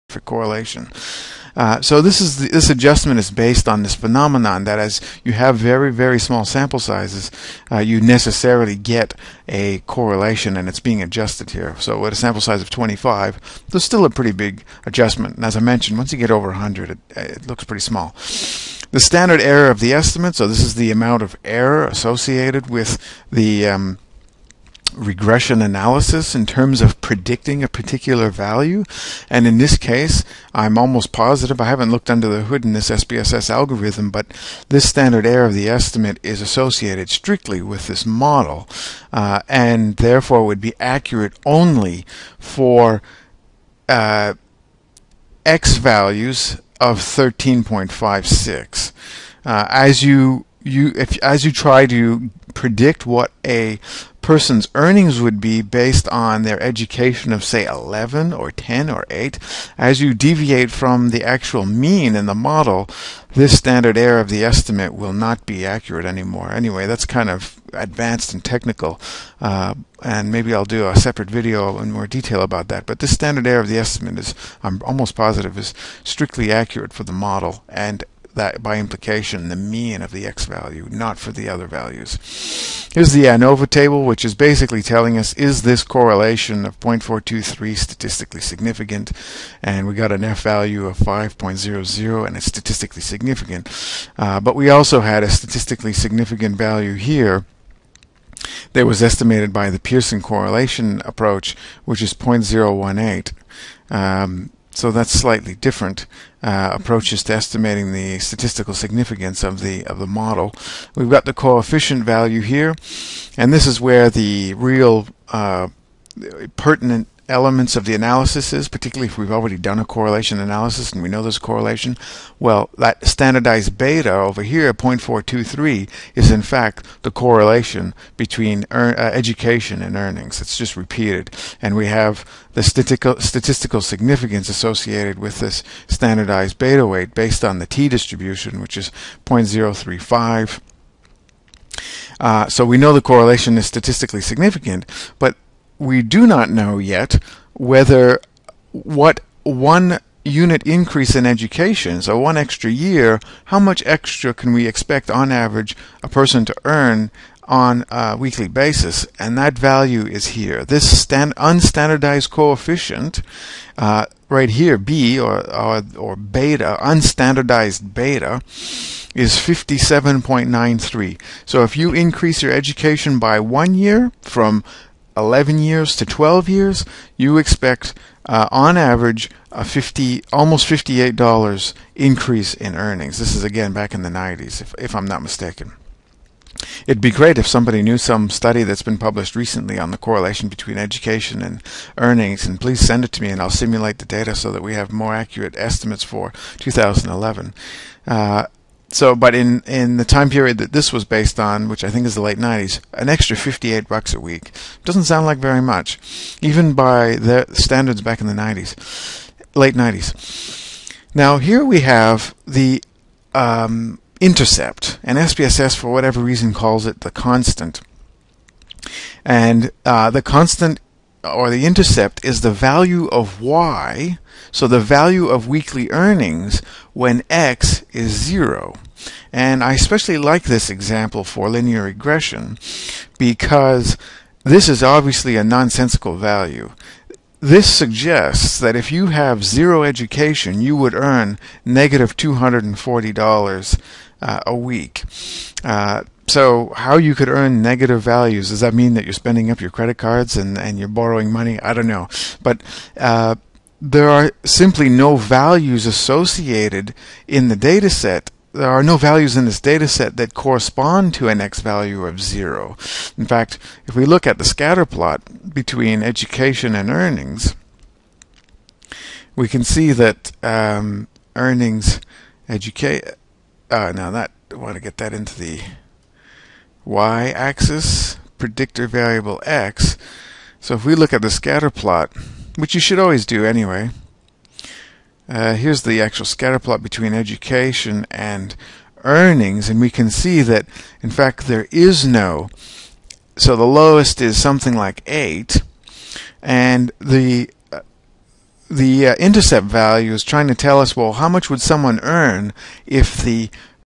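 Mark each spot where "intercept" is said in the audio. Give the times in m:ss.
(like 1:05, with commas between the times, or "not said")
3:34, 3:41, 4:59.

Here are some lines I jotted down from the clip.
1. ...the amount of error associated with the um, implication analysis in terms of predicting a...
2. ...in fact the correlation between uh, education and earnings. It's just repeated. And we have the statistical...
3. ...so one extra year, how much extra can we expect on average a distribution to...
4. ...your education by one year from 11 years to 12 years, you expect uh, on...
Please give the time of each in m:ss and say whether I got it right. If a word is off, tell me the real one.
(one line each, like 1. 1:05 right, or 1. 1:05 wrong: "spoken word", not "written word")
1. 0:20 wrong: "regression", not "implication"
2. 2:06 right
3. 2:32 wrong: "person", not "distribution"
4. 2:52 right.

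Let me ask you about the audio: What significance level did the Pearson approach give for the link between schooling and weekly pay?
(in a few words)
0.018.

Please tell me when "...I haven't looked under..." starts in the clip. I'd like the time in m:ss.
0:31.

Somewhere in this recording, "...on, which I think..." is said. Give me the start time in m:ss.
3:21.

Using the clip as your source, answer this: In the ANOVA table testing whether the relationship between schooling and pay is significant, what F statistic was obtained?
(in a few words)
5.00.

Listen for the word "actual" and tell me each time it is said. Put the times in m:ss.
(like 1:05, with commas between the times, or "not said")
1:01, 4:46.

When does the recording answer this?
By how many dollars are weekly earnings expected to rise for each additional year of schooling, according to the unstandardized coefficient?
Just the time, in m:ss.
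2:49.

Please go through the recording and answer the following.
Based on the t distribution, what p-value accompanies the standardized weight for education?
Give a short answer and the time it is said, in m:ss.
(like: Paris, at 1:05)
0.035, at 2:19.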